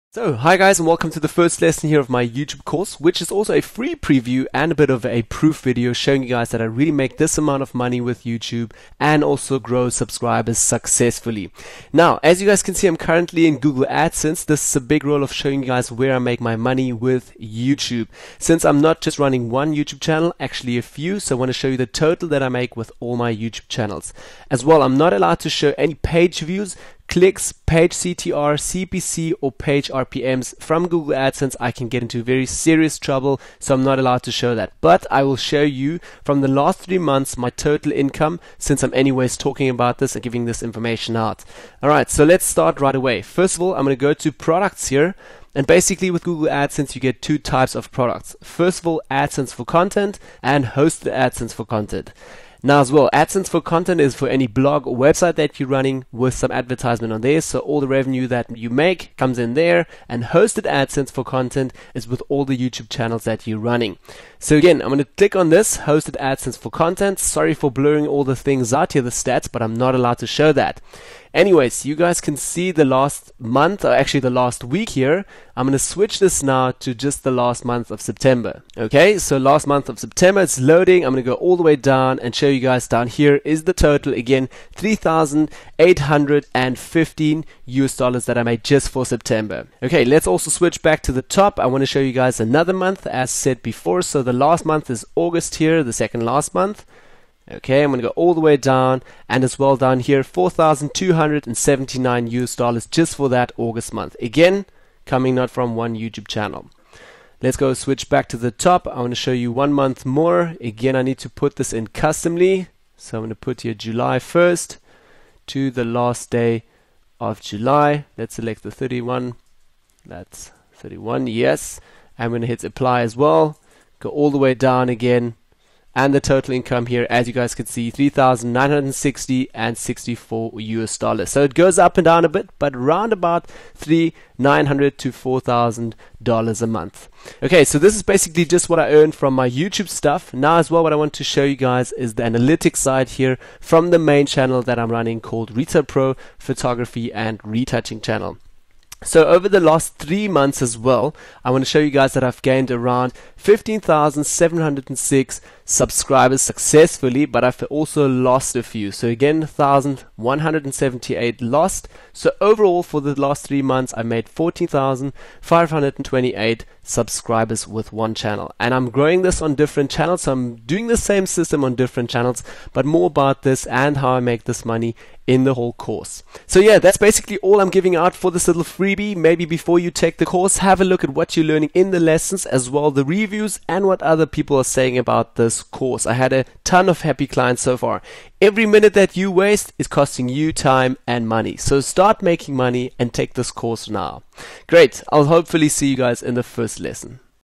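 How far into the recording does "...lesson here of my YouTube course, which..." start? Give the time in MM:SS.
00:01.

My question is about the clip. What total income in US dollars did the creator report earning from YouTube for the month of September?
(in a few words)
$3,815.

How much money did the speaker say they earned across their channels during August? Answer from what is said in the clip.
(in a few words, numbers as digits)
$4,279.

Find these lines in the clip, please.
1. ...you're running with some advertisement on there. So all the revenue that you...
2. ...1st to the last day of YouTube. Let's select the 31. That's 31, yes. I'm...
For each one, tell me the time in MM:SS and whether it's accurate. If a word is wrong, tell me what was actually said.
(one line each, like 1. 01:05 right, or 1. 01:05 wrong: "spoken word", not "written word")
1. 00:55 right
2. 01:54 wrong: "July", not "YouTube".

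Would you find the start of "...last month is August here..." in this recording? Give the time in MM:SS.
01:34.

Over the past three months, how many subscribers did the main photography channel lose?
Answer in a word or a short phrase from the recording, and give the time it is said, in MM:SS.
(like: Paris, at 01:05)
1,178, at 02:39.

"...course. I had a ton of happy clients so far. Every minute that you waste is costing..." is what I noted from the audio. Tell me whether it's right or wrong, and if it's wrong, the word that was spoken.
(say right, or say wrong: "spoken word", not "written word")
right.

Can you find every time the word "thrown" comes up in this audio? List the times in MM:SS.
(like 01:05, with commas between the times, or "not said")
not said.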